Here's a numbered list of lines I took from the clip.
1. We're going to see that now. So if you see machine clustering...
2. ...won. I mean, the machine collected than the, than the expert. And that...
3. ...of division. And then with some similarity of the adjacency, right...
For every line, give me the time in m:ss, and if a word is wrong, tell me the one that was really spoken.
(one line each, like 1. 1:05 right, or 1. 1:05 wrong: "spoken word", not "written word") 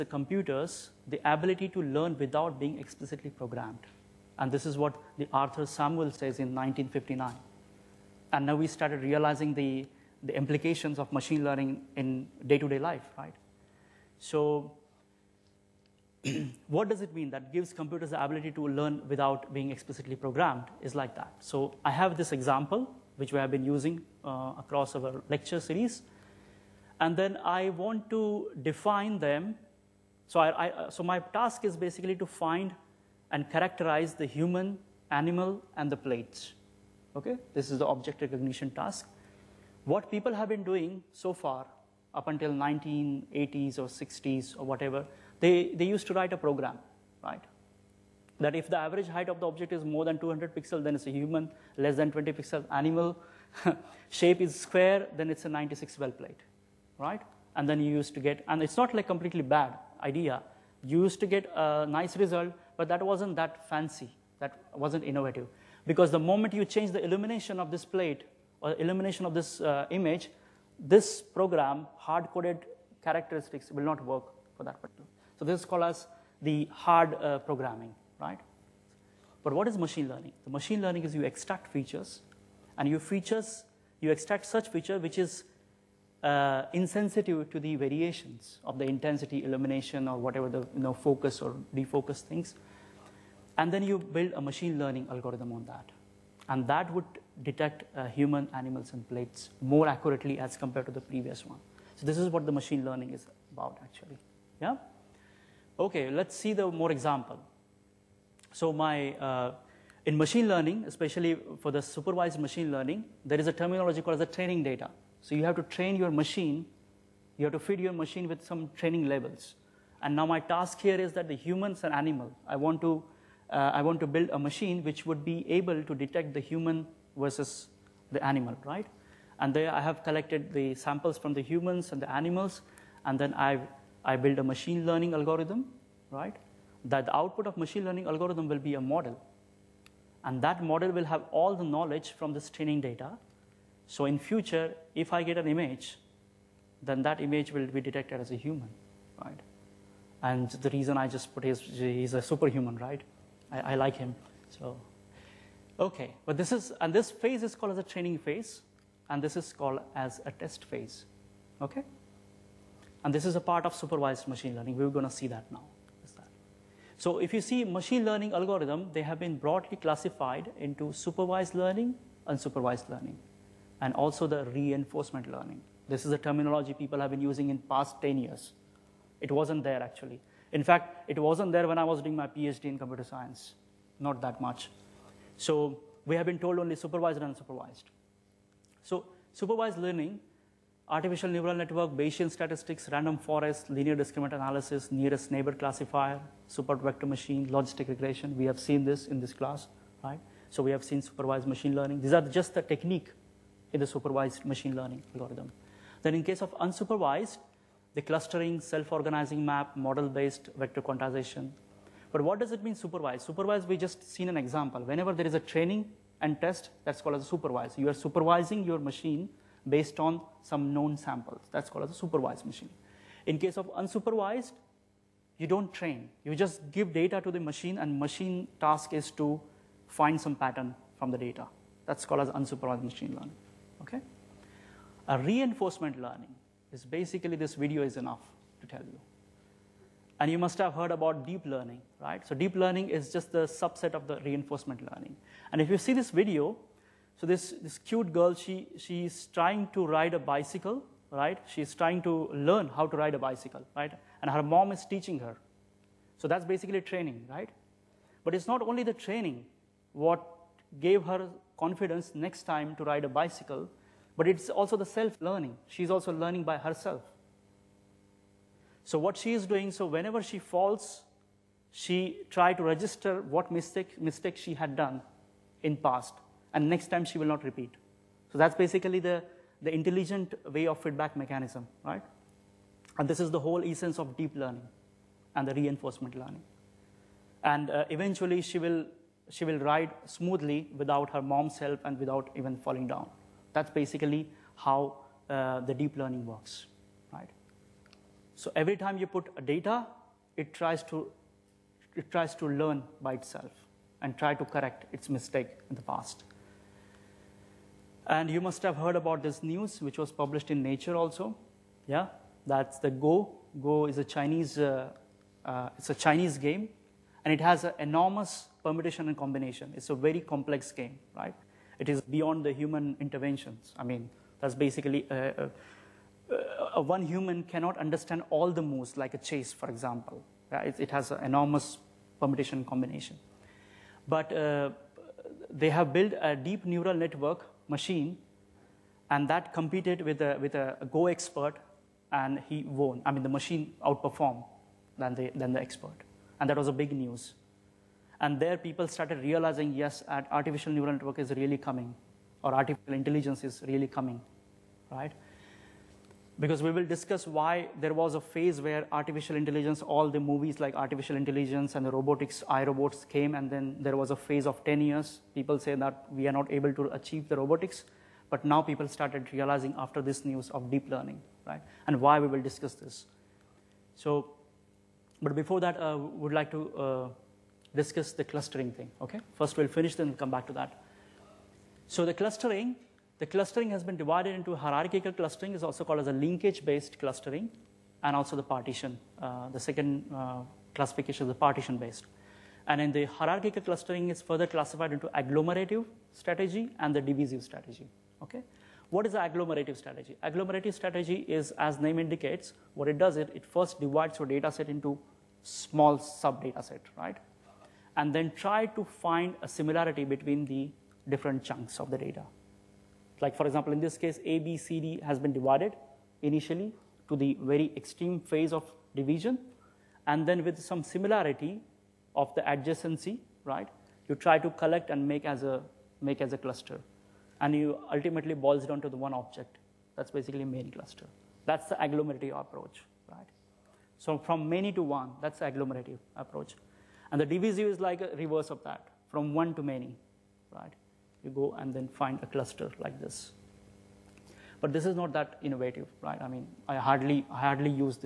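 1. 2:44 wrong: "learning", not "clustering"
2. 5:42 wrong: "outperformed", not "collected"
3. 6:58 right.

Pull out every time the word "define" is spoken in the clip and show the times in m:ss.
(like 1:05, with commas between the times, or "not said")
0:28.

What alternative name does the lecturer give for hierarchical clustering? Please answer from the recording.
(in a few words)
Linkage-based clustering.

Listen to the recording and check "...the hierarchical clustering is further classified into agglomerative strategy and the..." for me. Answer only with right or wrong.
right.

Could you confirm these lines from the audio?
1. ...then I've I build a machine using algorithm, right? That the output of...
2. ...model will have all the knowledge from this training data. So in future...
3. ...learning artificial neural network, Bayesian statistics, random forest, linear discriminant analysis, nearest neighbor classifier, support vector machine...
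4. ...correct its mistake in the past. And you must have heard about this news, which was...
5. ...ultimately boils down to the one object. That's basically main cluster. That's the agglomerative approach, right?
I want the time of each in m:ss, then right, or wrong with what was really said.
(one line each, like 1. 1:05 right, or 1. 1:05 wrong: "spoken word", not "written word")
1. 2:13 wrong: "learning", not "using"
2. 2:20 right
3. 3:09 right
4. 5:04 right
5. 7:07 right.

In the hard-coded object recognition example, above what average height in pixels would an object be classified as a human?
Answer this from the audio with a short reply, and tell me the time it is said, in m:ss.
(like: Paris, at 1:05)
200 pixels, at 0:50.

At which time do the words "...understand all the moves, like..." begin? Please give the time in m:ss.
5:27.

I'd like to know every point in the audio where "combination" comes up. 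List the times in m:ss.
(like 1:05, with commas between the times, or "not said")
5:19, 5:32.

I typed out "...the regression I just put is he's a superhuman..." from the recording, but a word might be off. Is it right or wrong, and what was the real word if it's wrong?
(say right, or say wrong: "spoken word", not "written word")
wrong: "reason", not "regression".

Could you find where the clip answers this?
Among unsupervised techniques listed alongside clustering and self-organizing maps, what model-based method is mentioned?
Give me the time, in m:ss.
3:30.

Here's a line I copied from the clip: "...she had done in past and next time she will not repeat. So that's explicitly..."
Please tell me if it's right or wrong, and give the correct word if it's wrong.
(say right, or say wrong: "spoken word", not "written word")
wrong: "basically", not "explicitly".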